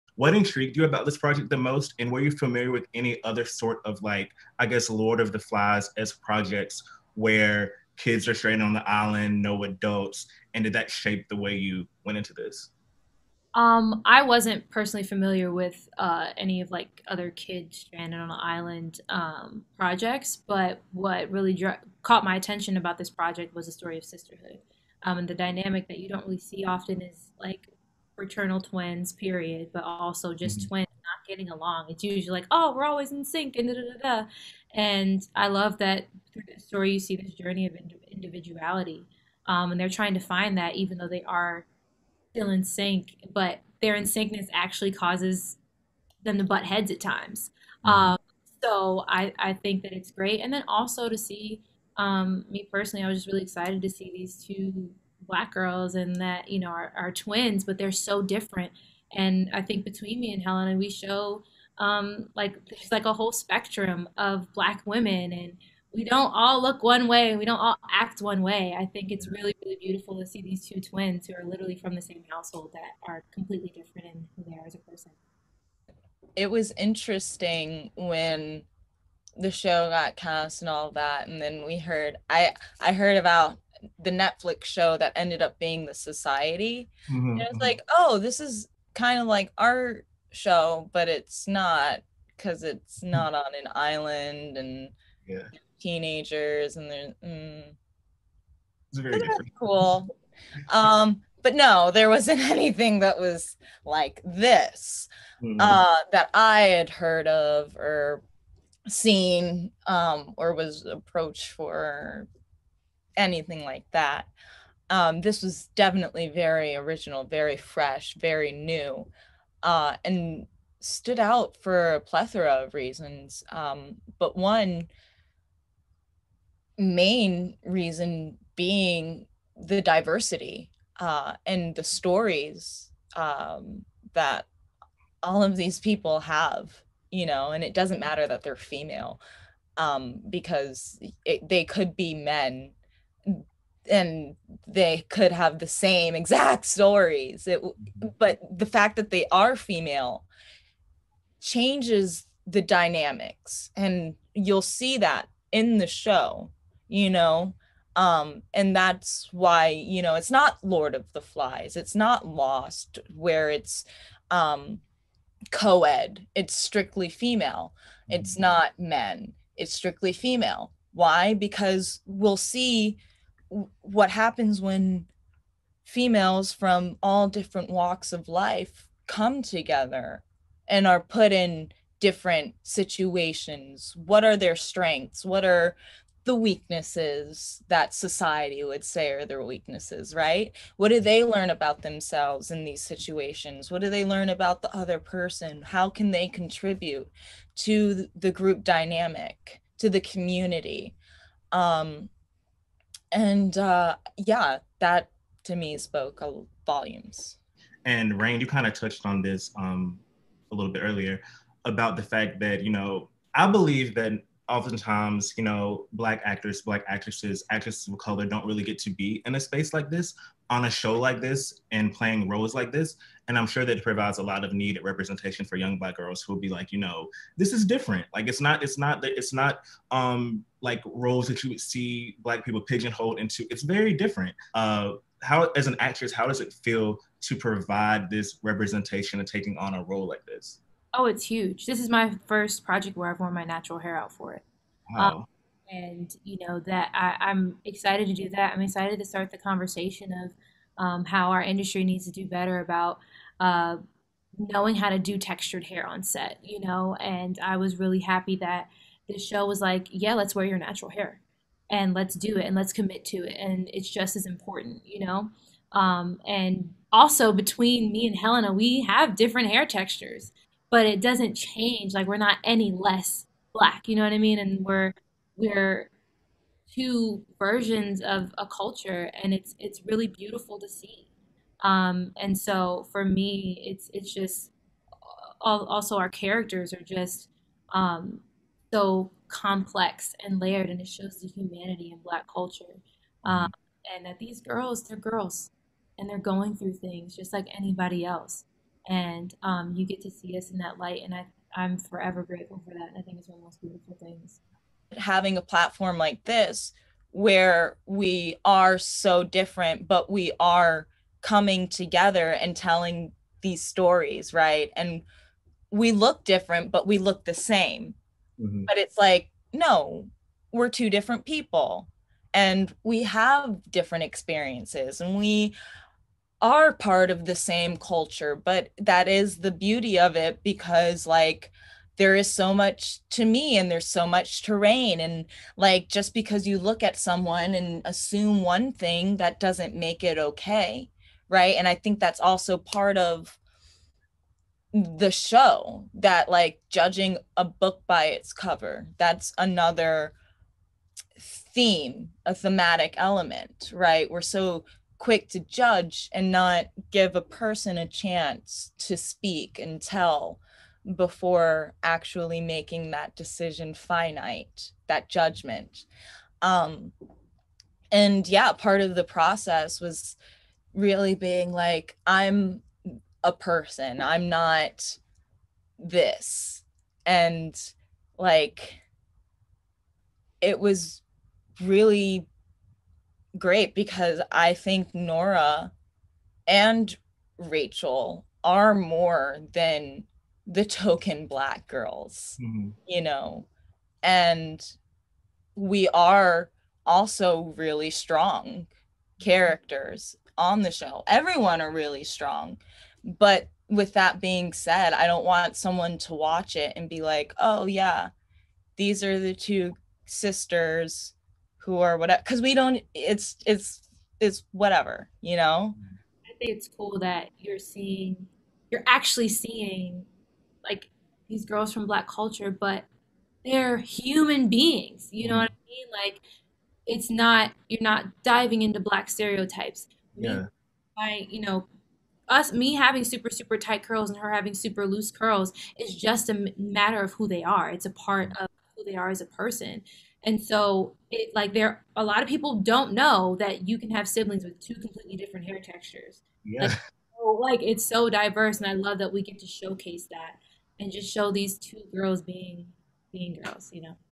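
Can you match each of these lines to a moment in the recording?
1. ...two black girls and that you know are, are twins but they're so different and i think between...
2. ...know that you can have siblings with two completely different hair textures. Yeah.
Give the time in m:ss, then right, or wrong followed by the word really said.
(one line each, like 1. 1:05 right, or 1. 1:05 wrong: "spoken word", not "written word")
1. 0:54 right
2. 7:22 right.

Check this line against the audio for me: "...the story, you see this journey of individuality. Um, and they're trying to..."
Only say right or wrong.
right.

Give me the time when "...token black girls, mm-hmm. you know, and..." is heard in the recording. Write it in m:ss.
6:30.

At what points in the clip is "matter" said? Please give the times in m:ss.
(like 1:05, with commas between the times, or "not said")
2:17, 7:16.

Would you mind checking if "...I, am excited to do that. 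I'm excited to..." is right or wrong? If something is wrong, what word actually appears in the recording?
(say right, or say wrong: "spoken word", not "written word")
right.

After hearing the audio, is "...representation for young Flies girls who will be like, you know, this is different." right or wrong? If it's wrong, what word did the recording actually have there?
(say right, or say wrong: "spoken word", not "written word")
wrong: "Black", not "Flies".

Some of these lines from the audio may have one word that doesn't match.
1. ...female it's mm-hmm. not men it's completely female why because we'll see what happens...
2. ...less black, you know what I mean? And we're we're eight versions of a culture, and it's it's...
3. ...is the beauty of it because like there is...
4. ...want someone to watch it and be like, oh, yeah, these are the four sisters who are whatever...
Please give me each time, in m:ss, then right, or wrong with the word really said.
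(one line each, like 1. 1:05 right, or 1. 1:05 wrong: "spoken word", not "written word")
1. 2:47 wrong: "strictly", not "completely"
2. 4:32 wrong: "two", not "eight"
3. 5:29 right
4. 6:45 wrong: "two", not "four".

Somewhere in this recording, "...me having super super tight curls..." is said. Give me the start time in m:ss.
7:12.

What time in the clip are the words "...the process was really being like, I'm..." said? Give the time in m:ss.
6:08.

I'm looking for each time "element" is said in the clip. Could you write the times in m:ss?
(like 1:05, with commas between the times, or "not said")
5:52.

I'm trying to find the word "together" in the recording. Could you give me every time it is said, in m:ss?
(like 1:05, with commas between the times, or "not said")
2:59, 5:11.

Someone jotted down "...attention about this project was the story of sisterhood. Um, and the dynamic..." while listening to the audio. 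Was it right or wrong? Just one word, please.
right.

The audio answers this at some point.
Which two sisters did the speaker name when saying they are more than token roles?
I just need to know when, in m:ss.
6:24.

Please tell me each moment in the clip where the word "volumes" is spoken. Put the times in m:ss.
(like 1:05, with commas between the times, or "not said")
3:26.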